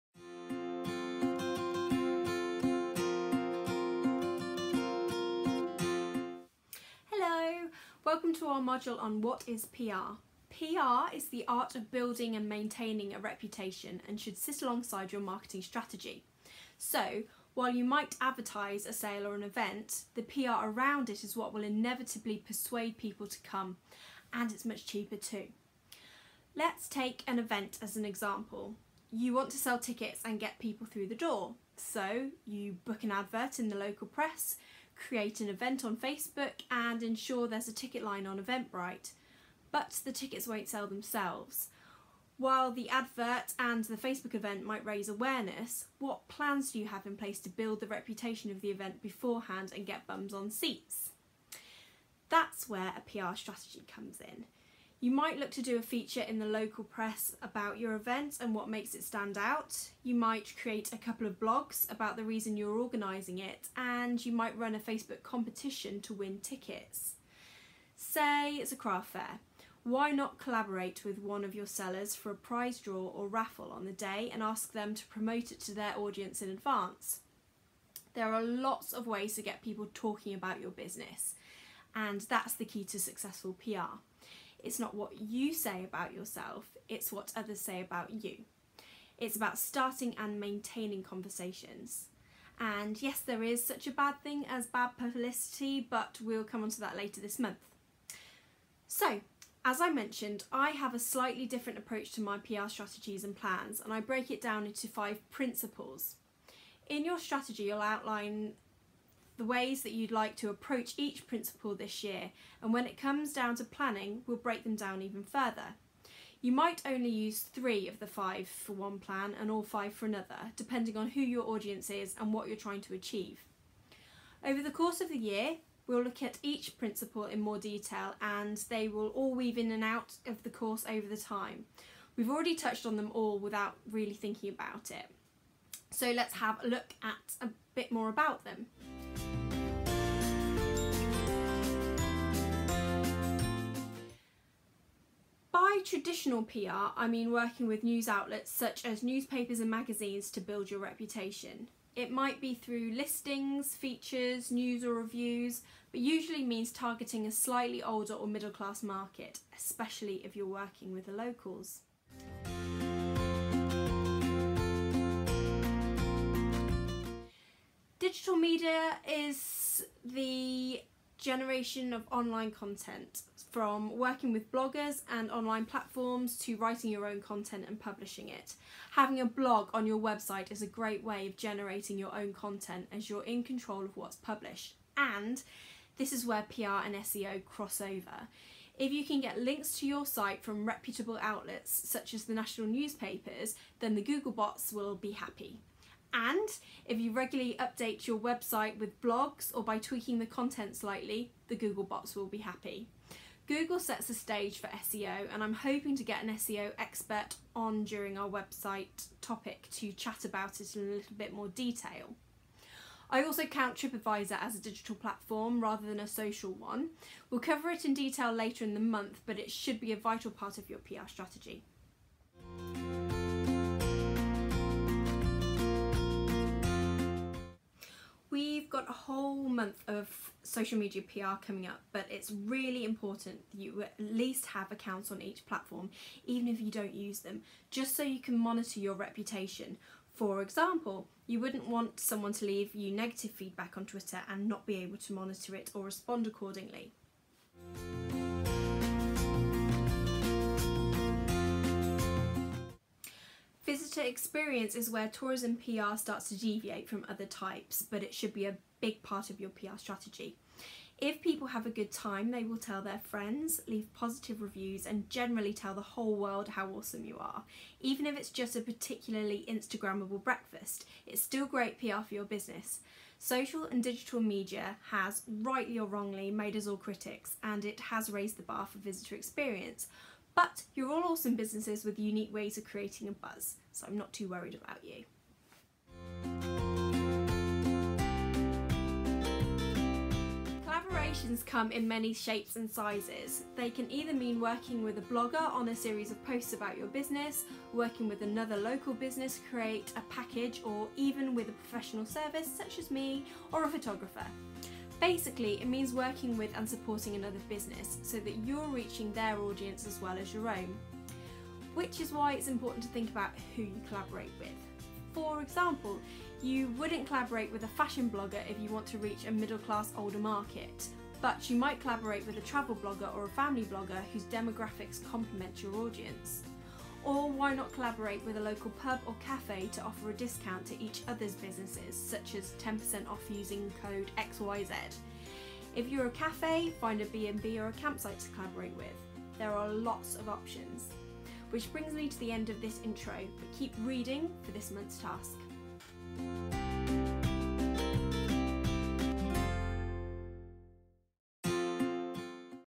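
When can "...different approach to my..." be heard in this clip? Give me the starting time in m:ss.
1:41.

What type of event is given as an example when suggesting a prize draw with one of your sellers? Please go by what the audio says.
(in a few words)
Craft fair.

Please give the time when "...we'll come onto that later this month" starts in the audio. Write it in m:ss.
1:36.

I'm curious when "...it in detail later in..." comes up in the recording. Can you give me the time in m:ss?
3:37.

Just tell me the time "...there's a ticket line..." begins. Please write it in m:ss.
0:37.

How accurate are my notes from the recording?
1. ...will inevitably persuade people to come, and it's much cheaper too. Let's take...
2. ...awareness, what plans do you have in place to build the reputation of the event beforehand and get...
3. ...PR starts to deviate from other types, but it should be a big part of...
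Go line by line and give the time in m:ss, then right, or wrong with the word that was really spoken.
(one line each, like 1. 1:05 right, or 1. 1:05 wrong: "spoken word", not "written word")
1. 0:21 right
2. 0:45 right
3. 4:15 right.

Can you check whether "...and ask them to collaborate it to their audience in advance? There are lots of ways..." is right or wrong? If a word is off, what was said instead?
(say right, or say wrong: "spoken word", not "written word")
wrong: "promote", not "collaborate".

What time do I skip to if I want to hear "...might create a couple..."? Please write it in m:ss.
1:00.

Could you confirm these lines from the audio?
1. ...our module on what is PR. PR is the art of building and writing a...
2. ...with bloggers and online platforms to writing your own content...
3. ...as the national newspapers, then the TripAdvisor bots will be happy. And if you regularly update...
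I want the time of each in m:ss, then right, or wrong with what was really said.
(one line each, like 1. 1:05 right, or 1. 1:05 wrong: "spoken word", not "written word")
1. 0:08 wrong: "maintaining", not "writing"
2. 2:54 right
3. 3:12 wrong: "Google", not "TripAdvisor".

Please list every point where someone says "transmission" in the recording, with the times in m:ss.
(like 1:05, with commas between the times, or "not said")
not said.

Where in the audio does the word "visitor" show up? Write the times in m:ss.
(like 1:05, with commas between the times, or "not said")
4:13, 4:38.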